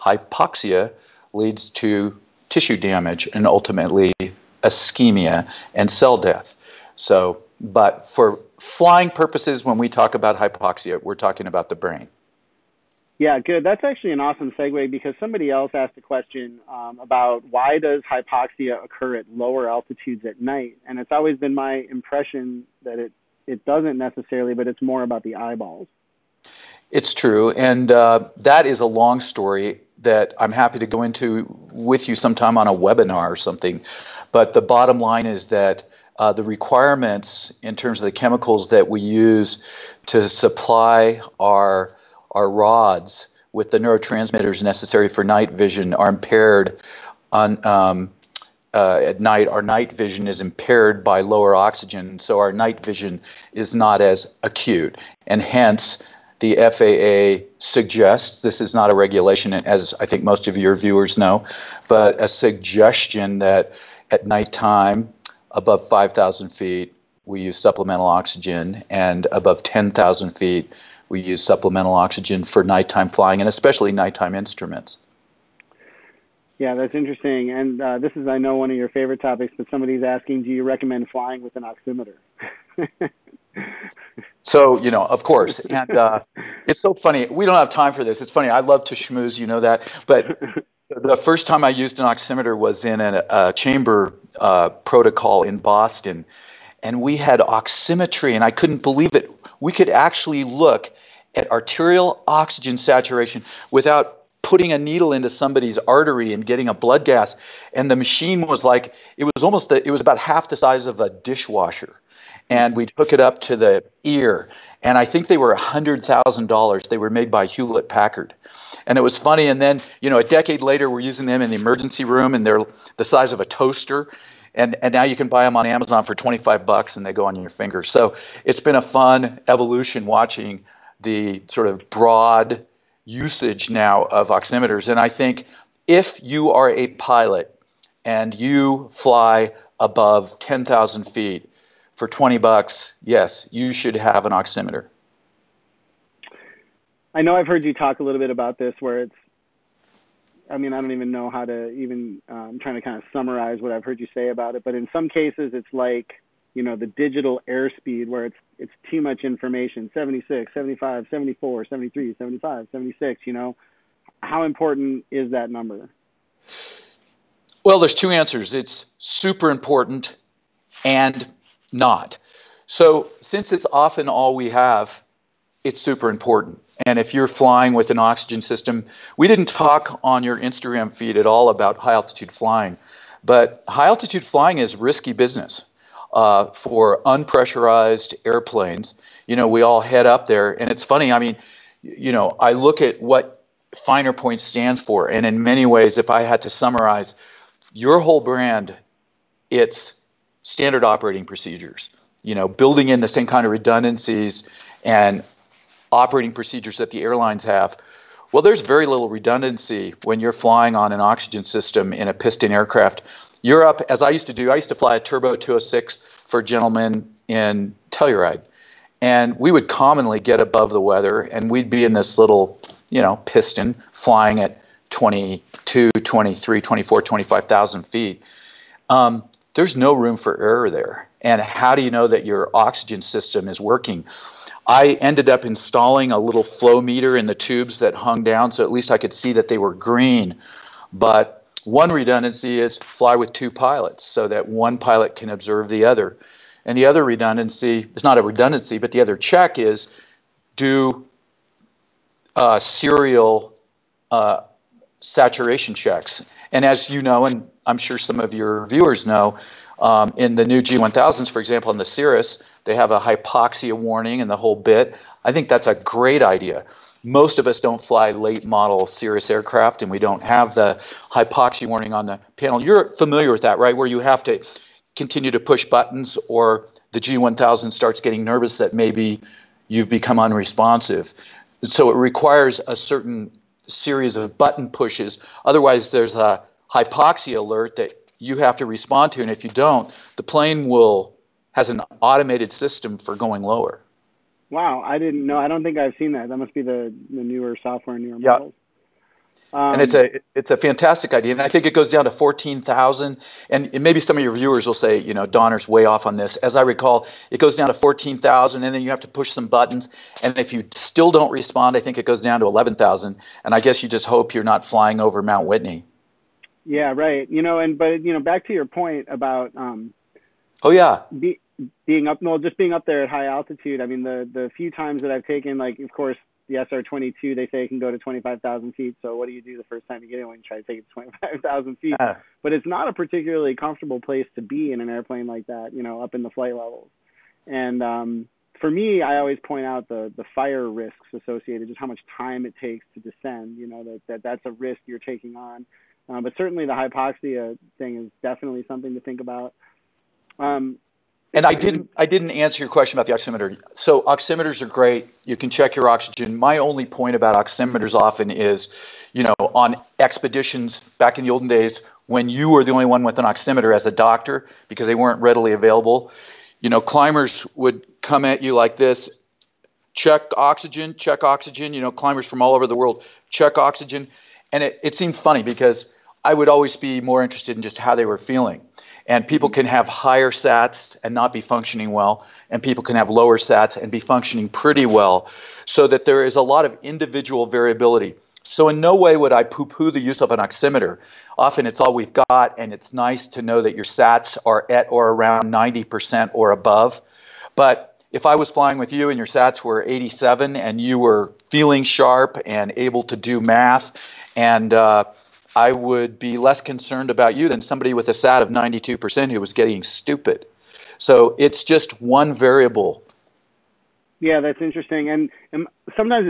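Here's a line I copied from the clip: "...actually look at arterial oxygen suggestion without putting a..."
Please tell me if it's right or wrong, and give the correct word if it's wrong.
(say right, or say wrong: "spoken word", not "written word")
wrong: "saturation", not "suggestion".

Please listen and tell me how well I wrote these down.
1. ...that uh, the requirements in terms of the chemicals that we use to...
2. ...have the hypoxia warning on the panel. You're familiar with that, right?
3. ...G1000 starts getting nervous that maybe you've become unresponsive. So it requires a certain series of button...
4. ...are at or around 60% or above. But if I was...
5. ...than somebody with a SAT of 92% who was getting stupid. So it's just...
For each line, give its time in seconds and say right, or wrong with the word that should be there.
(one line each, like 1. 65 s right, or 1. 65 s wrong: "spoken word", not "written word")
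1. 35 s right
2. 270 s right
3. 276 s right
4. 394 s wrong: "90", not "60"
5. 407 s right.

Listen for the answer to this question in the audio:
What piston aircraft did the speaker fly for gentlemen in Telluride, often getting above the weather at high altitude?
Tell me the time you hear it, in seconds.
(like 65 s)
214 s.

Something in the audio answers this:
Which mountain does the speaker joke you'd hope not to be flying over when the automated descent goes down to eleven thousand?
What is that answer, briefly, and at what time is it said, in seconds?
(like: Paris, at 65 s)
Mount Whitney, at 315 s.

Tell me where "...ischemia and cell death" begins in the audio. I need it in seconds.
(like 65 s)
4 s.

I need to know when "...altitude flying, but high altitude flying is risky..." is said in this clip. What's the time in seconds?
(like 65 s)
181 s.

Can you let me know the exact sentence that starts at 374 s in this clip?
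And it, it seemed funny because I would always be more interested in just how they were feeling.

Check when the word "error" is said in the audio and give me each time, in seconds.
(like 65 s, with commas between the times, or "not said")
230 s.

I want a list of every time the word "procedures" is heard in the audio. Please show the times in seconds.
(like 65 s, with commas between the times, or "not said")
201 s, 206 s.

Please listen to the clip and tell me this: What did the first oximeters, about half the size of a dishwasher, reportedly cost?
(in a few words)
$100,000.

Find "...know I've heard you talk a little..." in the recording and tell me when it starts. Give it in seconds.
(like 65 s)
147 s.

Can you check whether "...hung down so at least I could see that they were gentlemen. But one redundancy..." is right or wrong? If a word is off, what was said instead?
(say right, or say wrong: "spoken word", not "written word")
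wrong: "green", not "gentlemen".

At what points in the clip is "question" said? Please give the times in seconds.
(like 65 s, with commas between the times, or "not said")
16 s, 352 s.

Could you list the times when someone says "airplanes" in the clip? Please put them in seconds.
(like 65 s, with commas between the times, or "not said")
188 s, 334 s.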